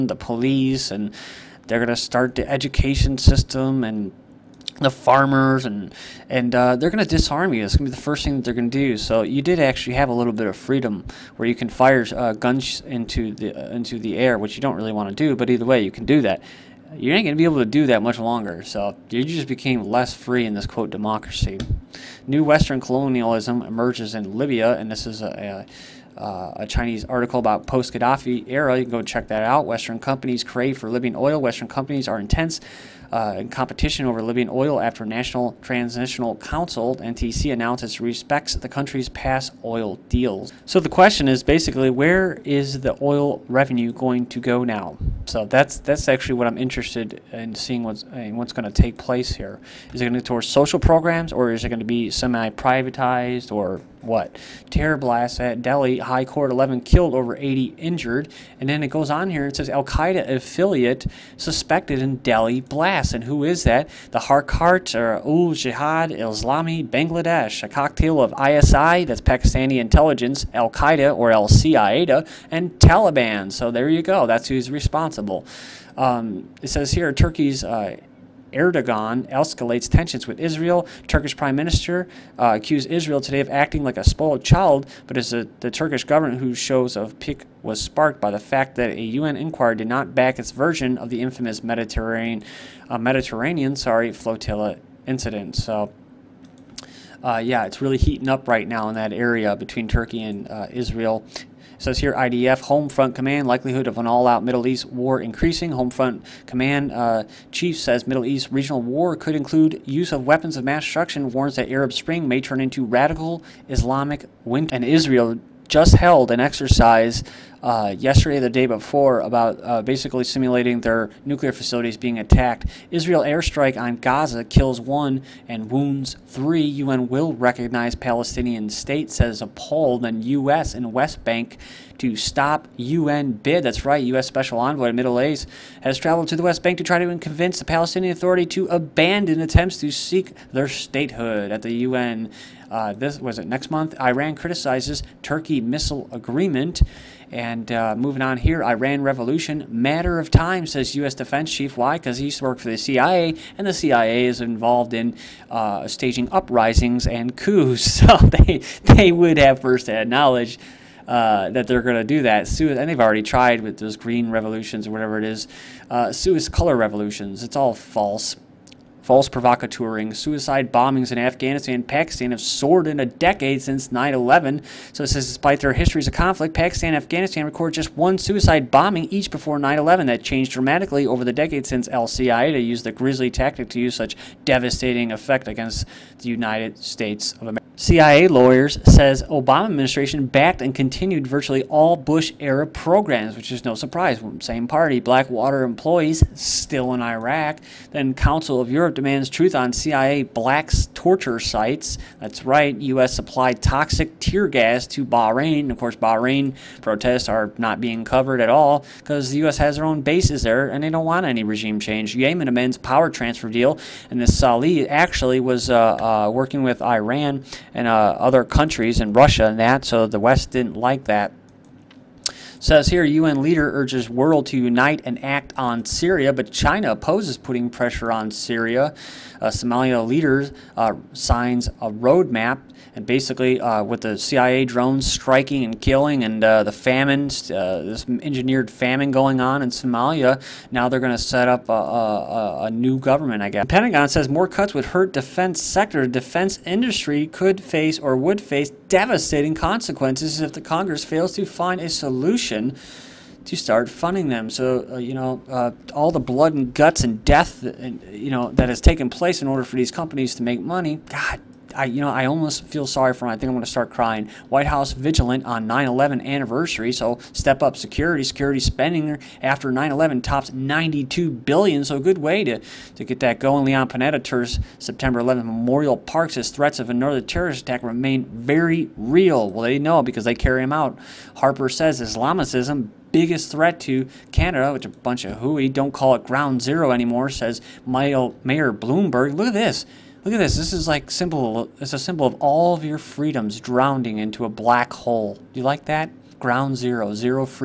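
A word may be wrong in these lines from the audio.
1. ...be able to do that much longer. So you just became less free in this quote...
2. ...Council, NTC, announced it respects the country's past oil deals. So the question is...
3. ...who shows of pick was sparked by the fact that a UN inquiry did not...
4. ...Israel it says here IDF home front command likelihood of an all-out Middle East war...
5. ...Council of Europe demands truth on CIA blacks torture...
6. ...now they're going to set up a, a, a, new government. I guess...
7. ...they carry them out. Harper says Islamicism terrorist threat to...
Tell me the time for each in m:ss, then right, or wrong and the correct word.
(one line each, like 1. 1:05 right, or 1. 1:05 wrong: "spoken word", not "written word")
1. 0:17 right
2. 0:36 right
3. 1:26 right
4. 1:40 right
5. 3:18 right
6. 4:00 right
7. 4:40 wrong: "biggest", not "terrorist".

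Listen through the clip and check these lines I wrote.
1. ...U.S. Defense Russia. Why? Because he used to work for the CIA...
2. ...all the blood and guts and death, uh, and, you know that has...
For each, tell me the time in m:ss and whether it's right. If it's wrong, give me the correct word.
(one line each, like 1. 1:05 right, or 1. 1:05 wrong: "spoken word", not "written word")
1. 2:30 wrong: "Chief", not "Russia"
2. 4:15 right.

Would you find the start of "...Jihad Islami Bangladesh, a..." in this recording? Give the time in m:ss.
1:05.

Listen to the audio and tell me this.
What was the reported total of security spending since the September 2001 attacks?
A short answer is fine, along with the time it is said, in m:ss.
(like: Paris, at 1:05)
92 billion, at 4:30.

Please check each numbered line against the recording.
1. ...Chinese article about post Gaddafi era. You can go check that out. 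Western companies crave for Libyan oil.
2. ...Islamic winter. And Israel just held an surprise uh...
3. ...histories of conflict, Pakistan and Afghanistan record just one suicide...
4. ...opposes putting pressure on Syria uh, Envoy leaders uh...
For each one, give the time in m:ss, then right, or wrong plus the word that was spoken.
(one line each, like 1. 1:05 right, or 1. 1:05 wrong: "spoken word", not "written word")
1. 0:26 right
2. 1:53 wrong: "exercise", not "surprise"
3. 2:55 right
4. 3:46 wrong: "Somalia", not "Envoy".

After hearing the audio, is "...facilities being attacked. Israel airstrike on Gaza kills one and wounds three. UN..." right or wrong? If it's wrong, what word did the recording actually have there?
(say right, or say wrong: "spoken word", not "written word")
right.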